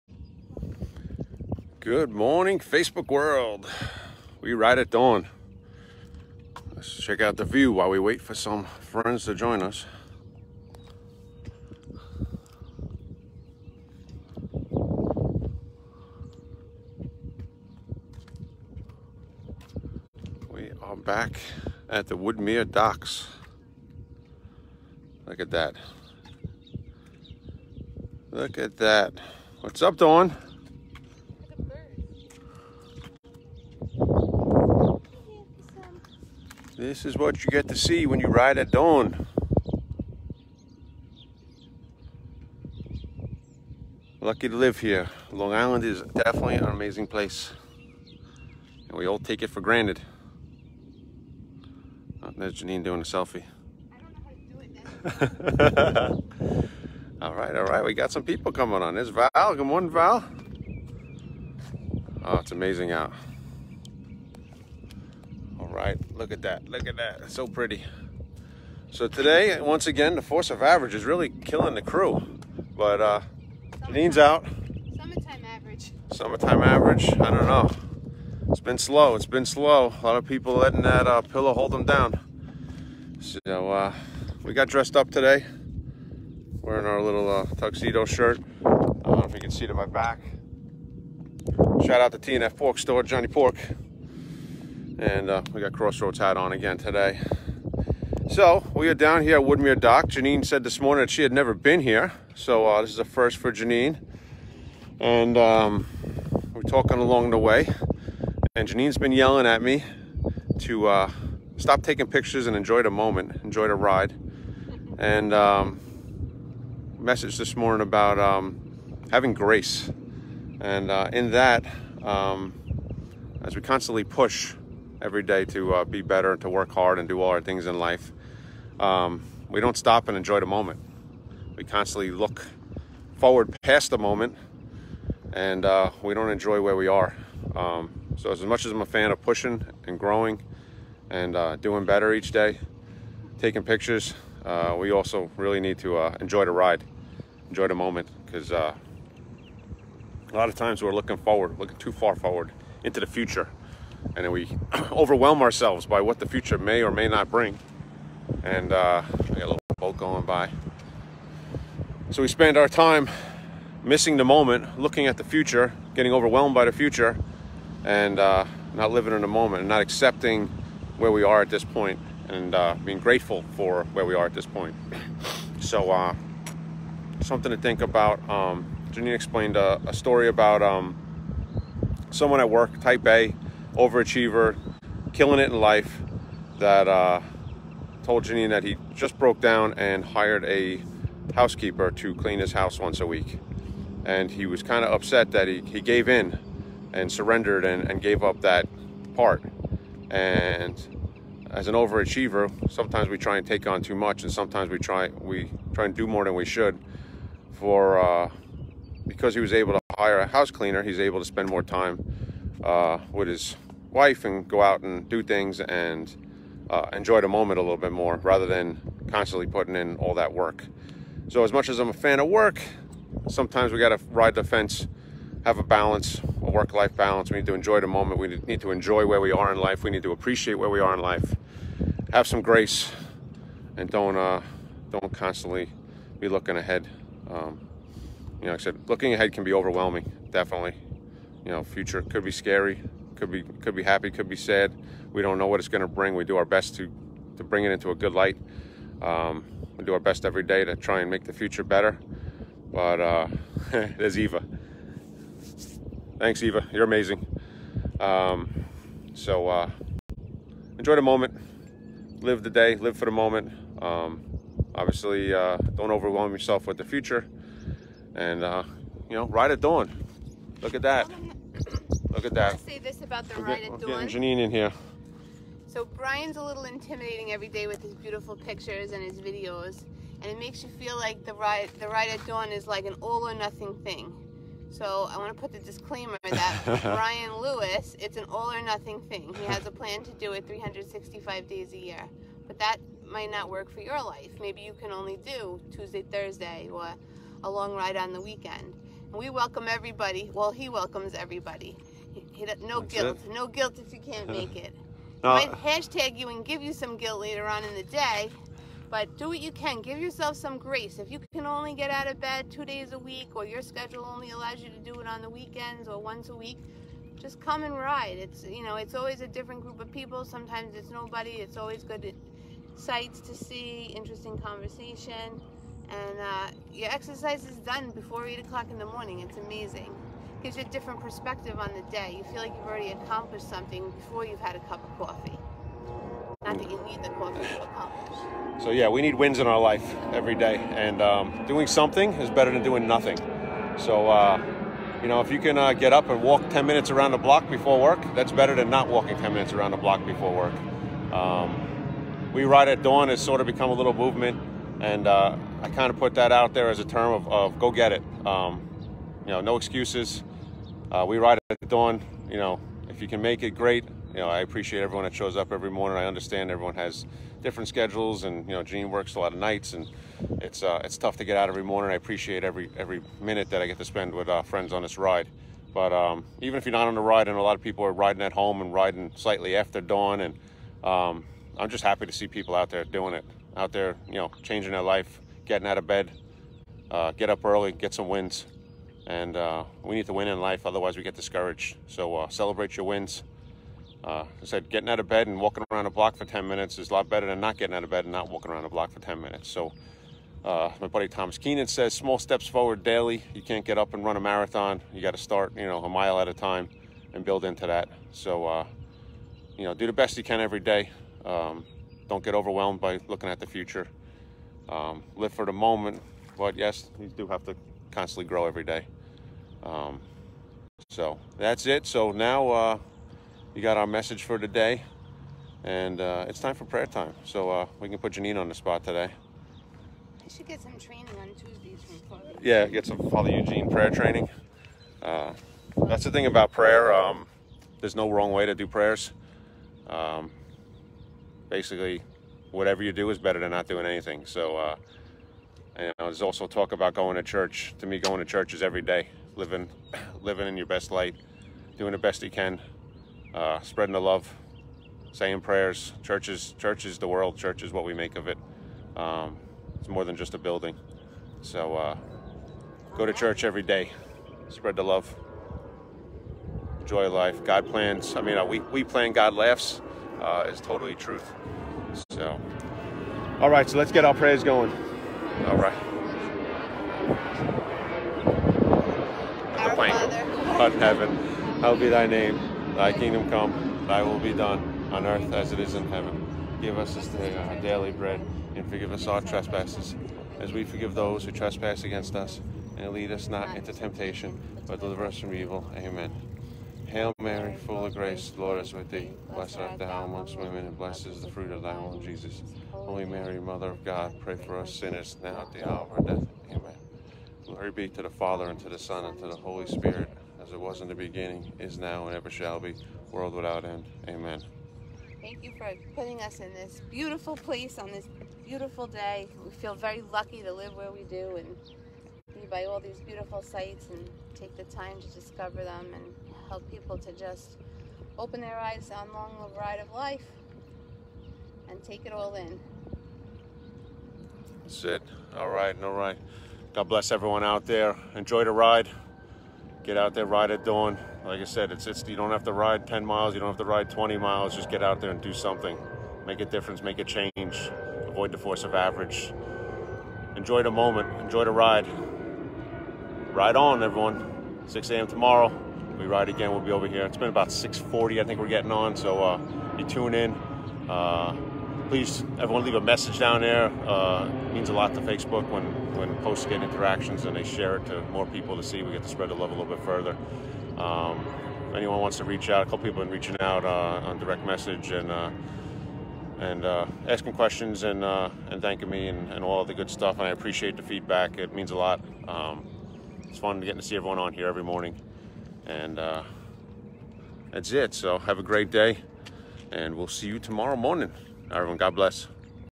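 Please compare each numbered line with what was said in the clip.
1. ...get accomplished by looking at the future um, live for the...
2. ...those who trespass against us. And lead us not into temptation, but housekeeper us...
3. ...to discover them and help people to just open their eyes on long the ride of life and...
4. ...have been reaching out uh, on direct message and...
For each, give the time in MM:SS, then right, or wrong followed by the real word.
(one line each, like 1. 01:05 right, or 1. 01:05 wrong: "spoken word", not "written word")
1. 06:52 wrong: "overwhelmed", not "accomplished"
2. 08:10 wrong: "deliver", not "housekeeper"
3. 08:44 right
4. 09:33 right.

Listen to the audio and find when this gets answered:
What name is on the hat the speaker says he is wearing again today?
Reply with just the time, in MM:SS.
01:35.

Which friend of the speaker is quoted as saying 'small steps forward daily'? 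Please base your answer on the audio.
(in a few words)
Thomas Keenan.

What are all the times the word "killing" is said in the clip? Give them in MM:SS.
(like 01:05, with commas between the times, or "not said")
01:11, 03:05.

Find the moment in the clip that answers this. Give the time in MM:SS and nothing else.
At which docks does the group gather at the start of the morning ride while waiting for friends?
00:22.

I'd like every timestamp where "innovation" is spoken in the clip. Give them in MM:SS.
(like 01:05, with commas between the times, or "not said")
not said.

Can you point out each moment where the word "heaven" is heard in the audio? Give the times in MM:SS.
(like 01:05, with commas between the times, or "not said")
08:00, 08:05.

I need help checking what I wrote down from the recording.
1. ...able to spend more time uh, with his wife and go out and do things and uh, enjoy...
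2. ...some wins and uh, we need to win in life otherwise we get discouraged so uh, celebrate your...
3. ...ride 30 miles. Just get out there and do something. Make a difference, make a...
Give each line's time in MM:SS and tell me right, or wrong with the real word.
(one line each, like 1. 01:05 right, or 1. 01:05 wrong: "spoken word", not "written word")
1. 03:30 right
2. 06:27 right
3. 09:03 wrong: "20", not "30".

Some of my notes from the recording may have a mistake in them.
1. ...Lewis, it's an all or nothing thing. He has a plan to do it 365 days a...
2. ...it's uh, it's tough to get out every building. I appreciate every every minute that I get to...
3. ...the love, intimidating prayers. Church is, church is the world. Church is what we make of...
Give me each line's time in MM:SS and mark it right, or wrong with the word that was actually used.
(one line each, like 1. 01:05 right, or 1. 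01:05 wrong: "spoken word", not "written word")
1. 04:47 right
2. 06:10 wrong: "morning", not "building"
3. 07:33 wrong: "saying", not "intimidating".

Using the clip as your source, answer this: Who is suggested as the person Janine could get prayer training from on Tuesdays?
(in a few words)
Father Eugene.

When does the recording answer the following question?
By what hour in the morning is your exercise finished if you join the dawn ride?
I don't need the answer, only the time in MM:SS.
05:28.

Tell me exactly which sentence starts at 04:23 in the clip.
Um, obviously, uh, don't overwhelm yourself with the future.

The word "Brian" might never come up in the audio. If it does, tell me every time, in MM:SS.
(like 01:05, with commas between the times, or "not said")
04:35, 04:46.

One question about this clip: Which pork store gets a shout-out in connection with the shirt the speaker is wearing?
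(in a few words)
TNF Pork Store.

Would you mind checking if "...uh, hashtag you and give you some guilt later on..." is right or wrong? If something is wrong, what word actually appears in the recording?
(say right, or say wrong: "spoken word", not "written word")
right.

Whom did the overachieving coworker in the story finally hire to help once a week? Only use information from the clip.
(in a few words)
A housekeeper.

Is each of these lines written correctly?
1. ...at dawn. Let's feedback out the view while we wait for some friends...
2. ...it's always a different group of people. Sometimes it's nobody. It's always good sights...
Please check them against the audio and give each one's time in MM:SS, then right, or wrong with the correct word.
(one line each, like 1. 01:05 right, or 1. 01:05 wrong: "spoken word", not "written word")
1. 00:04 wrong: "check", not "feedback"
2. 05:18 right.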